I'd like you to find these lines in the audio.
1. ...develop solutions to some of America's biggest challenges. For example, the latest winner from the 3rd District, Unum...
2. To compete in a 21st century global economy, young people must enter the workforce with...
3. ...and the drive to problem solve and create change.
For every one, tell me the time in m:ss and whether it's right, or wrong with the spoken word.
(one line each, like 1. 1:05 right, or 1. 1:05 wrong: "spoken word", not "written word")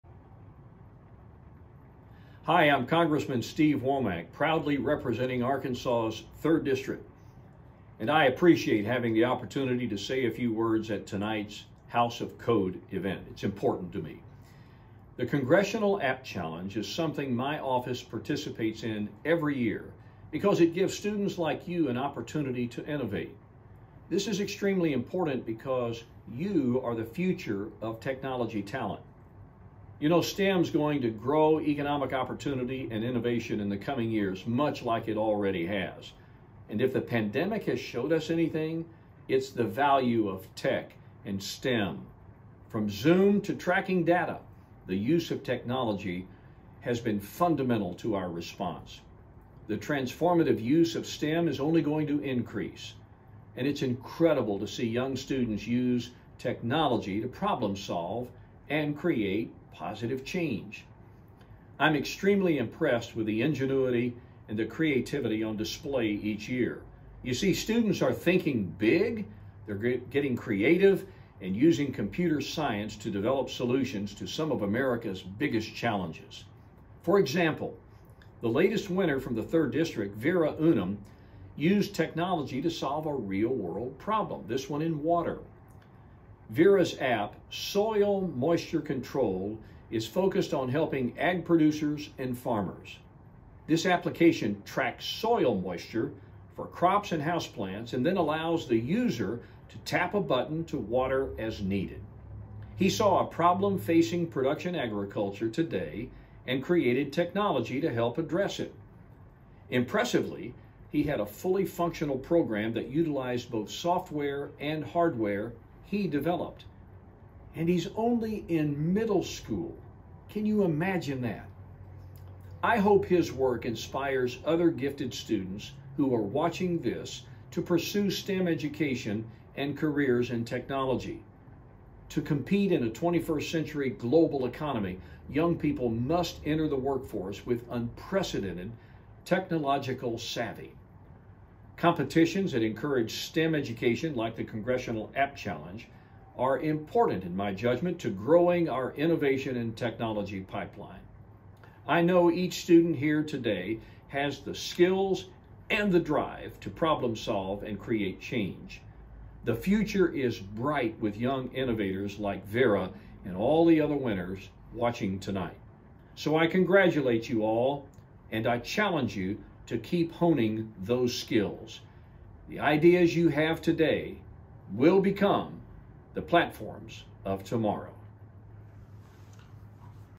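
1. 1:13 wrong: "Vera", not "Unum"
2. 2:12 right
3. 2:35 right.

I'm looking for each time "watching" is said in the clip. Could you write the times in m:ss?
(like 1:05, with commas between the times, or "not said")
2:06, 2:44.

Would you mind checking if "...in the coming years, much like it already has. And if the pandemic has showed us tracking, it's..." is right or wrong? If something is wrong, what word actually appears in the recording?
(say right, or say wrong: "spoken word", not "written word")
wrong: "anything", not "tracking".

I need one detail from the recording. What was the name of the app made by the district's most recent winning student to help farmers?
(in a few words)
Soil Moisture Control.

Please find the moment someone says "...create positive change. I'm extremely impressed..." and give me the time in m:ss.
0:58.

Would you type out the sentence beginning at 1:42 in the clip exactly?
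He saw a problem facing production agriculture today and created technology to help address it.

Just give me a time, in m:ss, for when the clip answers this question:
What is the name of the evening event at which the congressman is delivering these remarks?
0:11.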